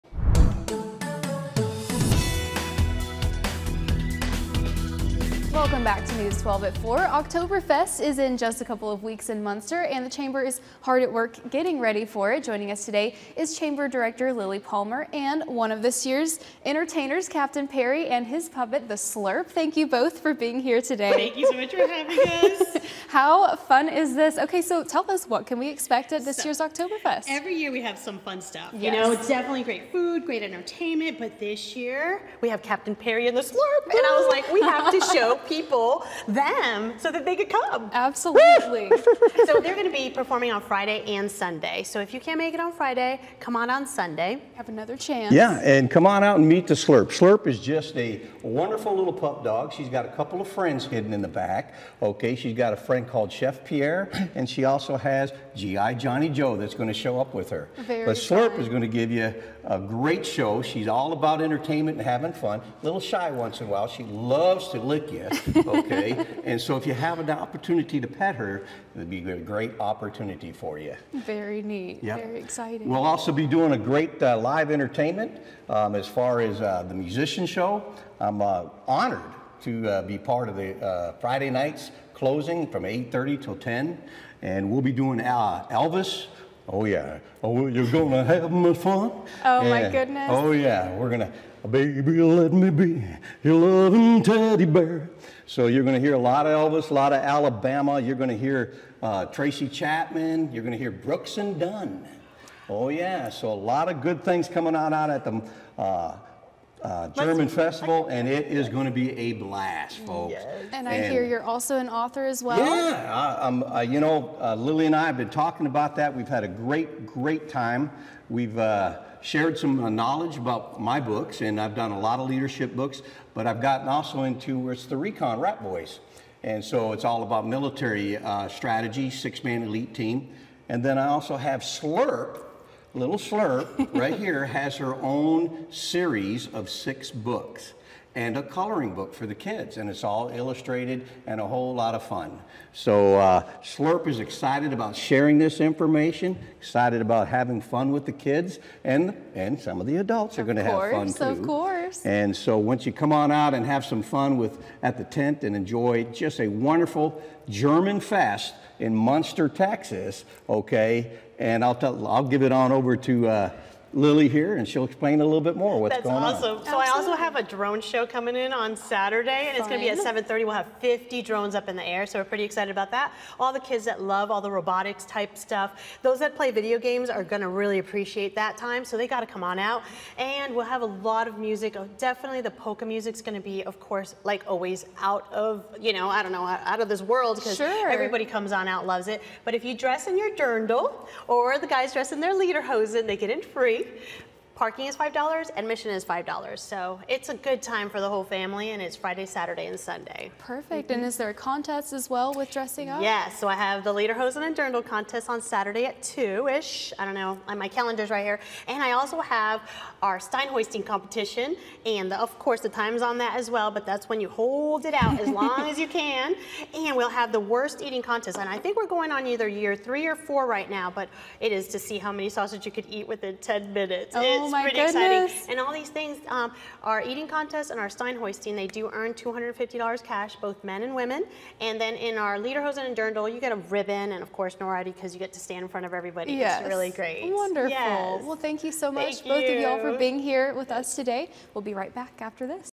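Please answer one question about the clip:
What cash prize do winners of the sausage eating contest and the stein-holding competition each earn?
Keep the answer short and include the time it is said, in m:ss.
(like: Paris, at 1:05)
$250, at 3:49.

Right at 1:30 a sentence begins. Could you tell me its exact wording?
We're going to, baby, let me be your loving teddy bear.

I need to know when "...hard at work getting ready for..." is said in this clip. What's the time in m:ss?
0:10.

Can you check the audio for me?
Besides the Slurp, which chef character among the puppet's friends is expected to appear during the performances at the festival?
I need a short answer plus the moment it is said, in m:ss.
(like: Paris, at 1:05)
Chef Pierre, at 0:53.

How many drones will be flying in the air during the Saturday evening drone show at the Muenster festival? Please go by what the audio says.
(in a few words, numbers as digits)
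50.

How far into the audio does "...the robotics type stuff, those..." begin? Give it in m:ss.
2:54.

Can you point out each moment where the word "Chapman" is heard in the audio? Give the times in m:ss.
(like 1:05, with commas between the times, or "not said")
1:39.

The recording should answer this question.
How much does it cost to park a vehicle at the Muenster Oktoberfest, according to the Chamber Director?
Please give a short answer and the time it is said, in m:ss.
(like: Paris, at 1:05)
$5, at 3:14.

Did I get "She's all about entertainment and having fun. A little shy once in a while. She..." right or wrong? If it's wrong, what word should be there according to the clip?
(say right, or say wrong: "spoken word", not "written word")
right.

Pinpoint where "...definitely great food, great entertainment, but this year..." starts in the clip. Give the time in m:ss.
0:29.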